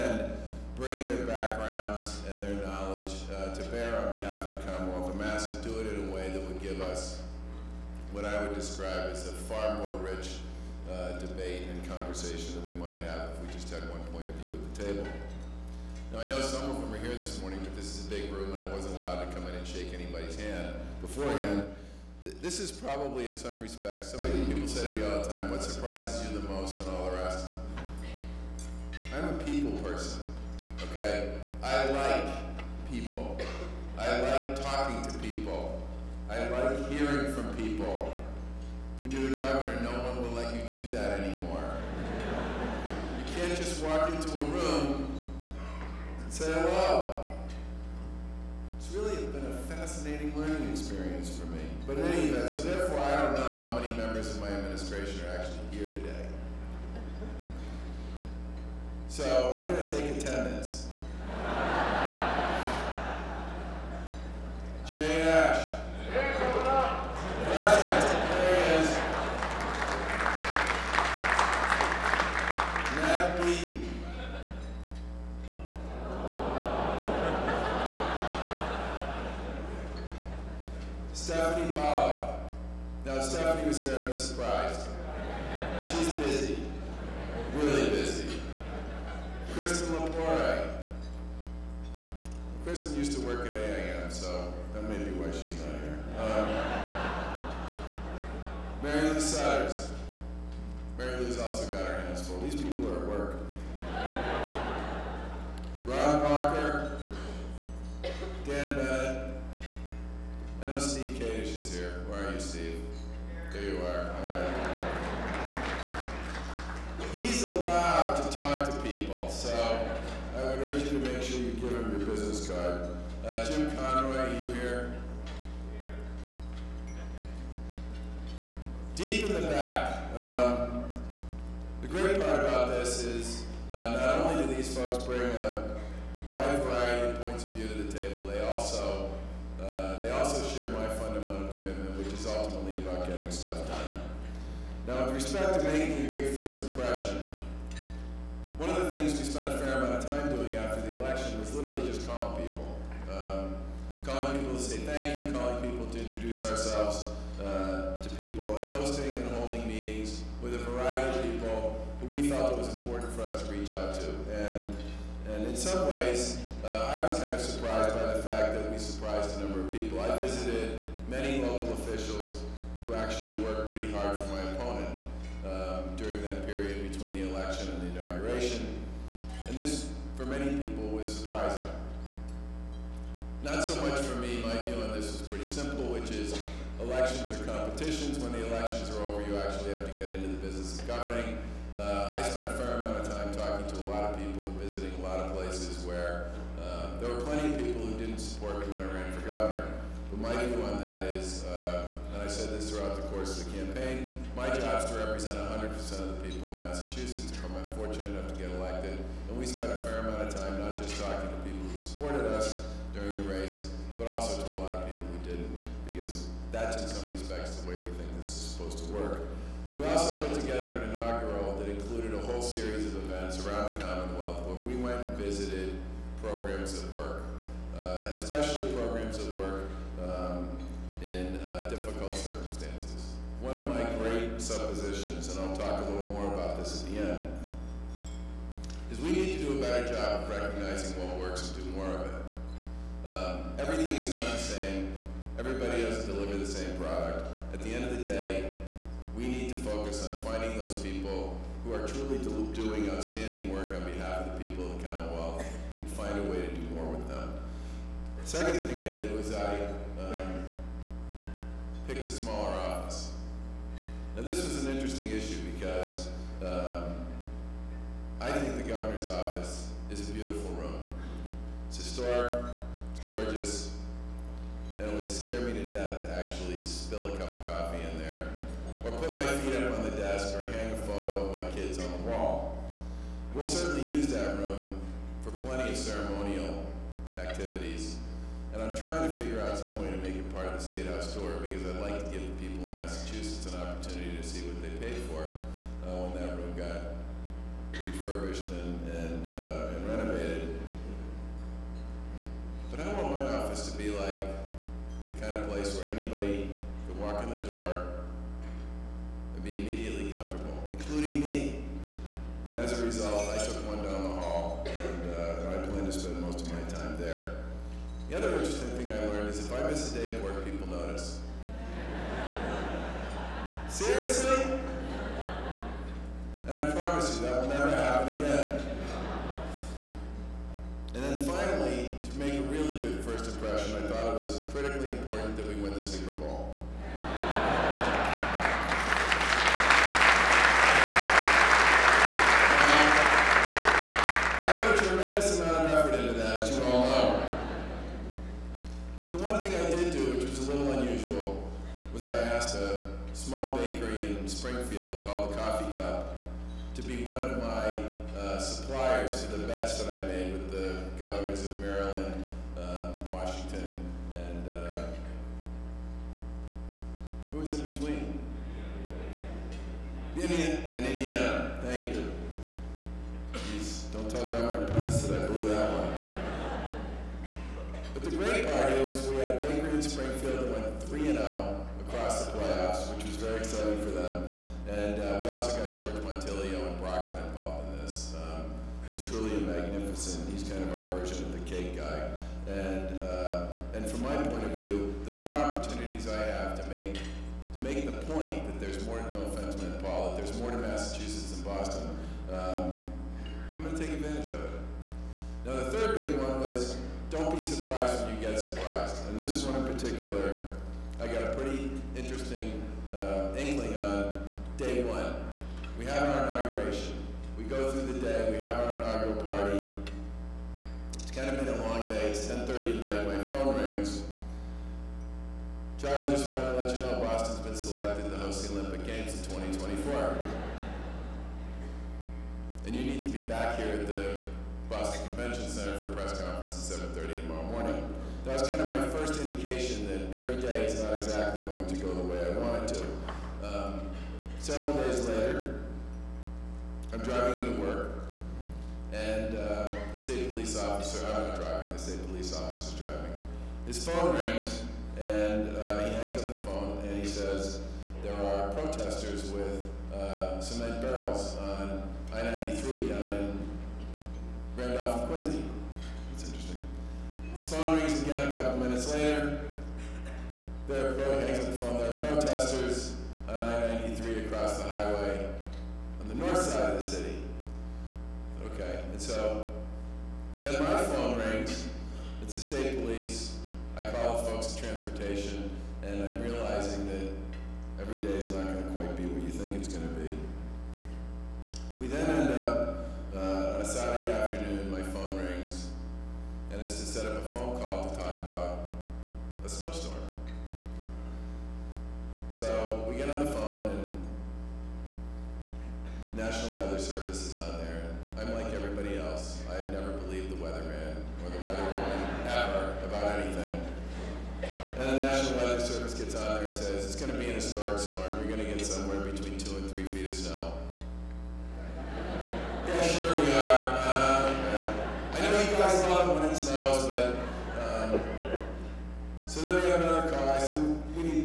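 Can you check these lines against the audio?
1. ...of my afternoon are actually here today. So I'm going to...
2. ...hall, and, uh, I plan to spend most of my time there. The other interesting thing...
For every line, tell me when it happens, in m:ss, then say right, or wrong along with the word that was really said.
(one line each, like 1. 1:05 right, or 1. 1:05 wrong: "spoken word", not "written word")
1. 0:54 wrong: "administration", not "afternoon"
2. 5:14 right.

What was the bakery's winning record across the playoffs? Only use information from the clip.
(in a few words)
3 and 0.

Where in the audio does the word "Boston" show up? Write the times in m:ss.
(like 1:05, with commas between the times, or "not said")
6:41, 7:07, 7:14.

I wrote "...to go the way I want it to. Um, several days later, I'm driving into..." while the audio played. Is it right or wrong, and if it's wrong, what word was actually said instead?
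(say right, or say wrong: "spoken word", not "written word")
right.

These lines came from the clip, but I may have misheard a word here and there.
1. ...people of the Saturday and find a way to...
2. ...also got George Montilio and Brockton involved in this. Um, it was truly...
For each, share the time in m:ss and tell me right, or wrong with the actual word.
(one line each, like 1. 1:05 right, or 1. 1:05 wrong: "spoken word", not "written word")
1. 4:14 wrong: "Commonwealth", not "Saturday"
2. 6:25 right.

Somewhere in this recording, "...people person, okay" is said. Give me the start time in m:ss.
0:29.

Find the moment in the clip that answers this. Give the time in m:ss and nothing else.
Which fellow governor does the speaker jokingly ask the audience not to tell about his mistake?
6:14.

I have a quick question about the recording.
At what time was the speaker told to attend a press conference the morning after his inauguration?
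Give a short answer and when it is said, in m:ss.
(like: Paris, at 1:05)
7:30, at 7:16.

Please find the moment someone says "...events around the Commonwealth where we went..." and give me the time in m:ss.
3:42.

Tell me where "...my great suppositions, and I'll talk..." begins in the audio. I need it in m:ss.
3:53.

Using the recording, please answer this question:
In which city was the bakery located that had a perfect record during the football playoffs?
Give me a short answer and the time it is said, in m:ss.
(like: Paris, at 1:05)
Springfield, at 6:19.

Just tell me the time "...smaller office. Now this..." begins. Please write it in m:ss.
4:22.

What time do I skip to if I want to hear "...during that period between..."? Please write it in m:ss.
2:55.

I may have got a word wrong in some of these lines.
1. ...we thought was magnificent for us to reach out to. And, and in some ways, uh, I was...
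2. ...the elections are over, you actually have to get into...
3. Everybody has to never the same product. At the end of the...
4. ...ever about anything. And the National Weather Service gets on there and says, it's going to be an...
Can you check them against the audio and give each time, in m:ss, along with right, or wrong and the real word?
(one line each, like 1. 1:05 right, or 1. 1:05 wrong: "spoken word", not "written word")
1. 2:42 wrong: "important", not "magnificent"
2. 3:08 right
3. 4:05 wrong: "deliver", not "never"
4. 8:32 right.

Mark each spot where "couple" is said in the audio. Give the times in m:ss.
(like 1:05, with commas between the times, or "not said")
7:48.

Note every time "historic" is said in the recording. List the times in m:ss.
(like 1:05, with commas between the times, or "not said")
4:31, 8:37.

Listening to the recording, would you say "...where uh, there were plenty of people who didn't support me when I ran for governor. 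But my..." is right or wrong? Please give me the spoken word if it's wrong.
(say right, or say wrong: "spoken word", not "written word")
right.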